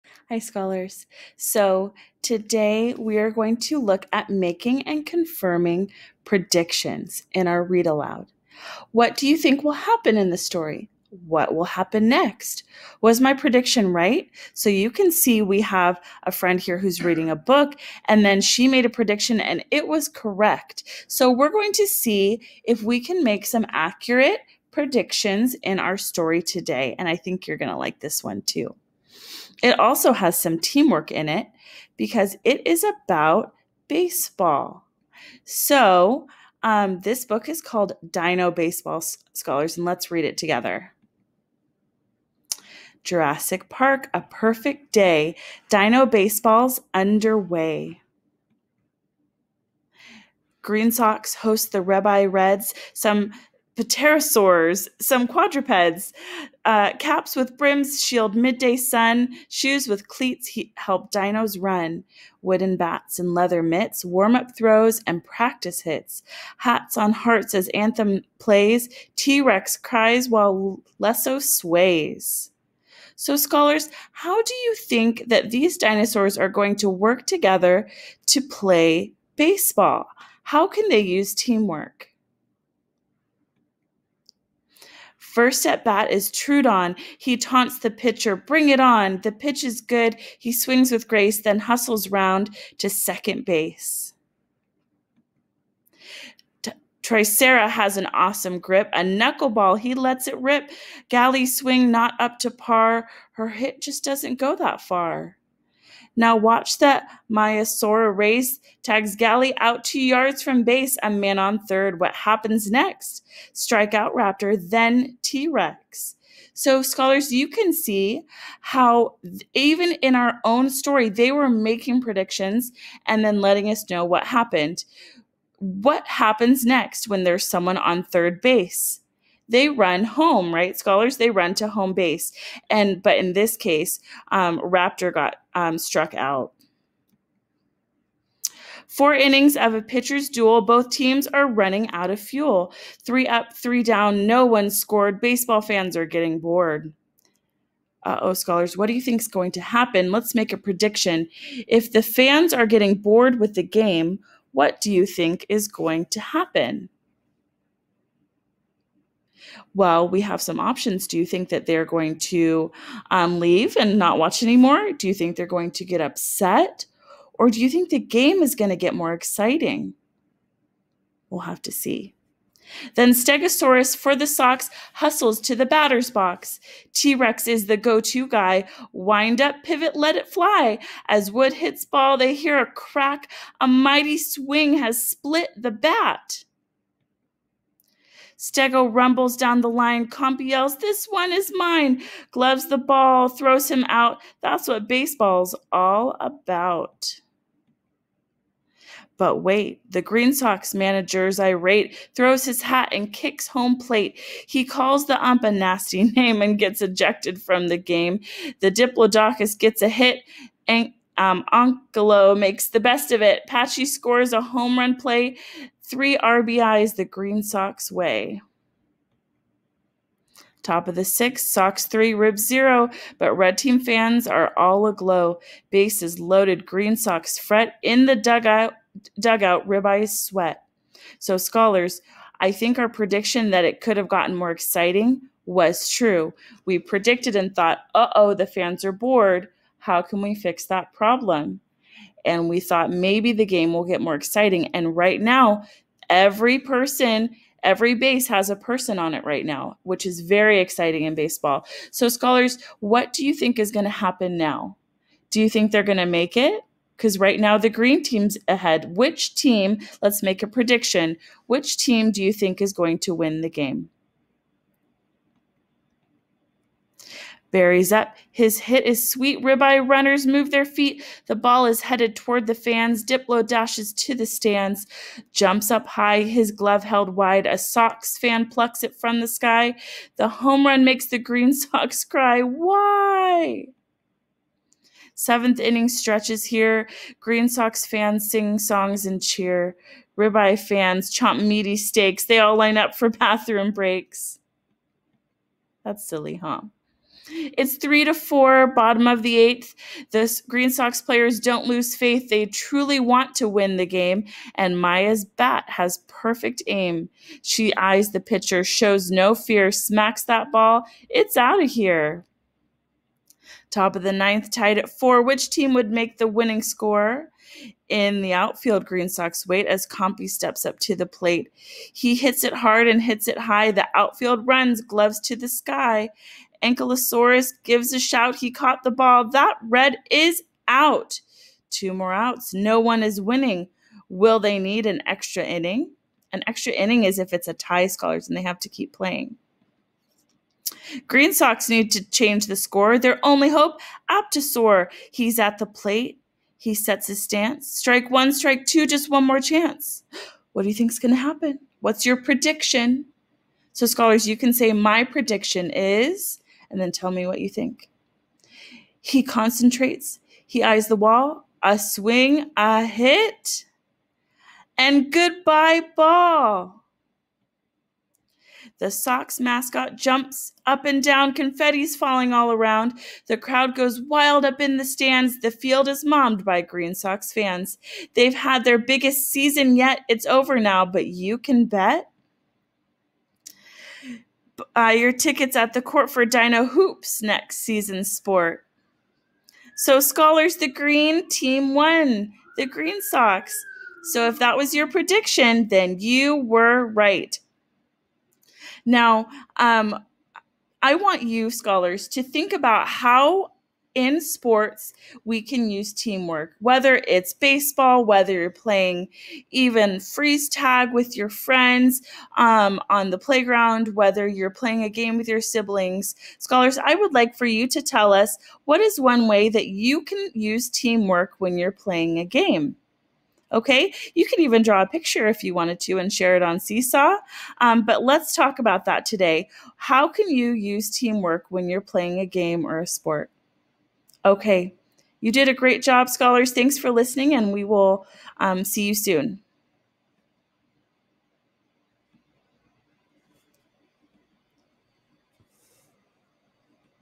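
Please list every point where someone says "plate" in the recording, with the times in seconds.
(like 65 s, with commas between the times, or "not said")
203 s, 321 s, 345 s.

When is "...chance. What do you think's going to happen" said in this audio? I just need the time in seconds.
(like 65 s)
349 s.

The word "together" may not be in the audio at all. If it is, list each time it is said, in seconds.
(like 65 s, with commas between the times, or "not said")
40 s, 77 s.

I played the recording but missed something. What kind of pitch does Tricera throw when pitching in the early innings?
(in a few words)
knuckleball.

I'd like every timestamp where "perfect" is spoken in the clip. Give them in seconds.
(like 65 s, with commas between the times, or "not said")
44 s, 306 s.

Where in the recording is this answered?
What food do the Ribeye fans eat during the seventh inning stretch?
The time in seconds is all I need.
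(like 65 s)
291 s.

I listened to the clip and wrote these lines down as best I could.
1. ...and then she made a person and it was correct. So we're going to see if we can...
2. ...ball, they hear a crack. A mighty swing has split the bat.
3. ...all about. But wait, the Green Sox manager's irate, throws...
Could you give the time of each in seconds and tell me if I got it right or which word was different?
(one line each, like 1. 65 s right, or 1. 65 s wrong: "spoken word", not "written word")
1. 18 s wrong: "prediction", not "person"
2. 181 s right
3. 195 s right.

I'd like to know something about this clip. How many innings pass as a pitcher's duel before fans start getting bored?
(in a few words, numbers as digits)
4.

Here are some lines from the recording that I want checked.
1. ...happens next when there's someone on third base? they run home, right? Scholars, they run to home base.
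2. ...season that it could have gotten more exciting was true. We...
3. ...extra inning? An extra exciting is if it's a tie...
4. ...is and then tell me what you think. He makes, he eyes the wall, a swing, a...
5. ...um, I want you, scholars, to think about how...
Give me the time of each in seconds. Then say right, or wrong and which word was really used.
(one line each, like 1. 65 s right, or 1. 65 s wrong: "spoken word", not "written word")
1. 126 s right
2. 232 s wrong: "prediction", not "season"
3. 335 s wrong: "inning", not "exciting"
4. 355 s wrong: "concentrates", not "makes"
5. 399 s right.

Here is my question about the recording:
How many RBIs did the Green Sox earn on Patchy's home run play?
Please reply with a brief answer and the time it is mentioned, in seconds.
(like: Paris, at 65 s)
3, at 215 s.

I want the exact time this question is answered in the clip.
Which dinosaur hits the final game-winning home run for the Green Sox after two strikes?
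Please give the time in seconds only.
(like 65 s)
344 s.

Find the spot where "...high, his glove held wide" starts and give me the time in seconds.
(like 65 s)
275 s.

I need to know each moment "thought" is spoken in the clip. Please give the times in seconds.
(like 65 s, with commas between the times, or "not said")
237 s, 242 s.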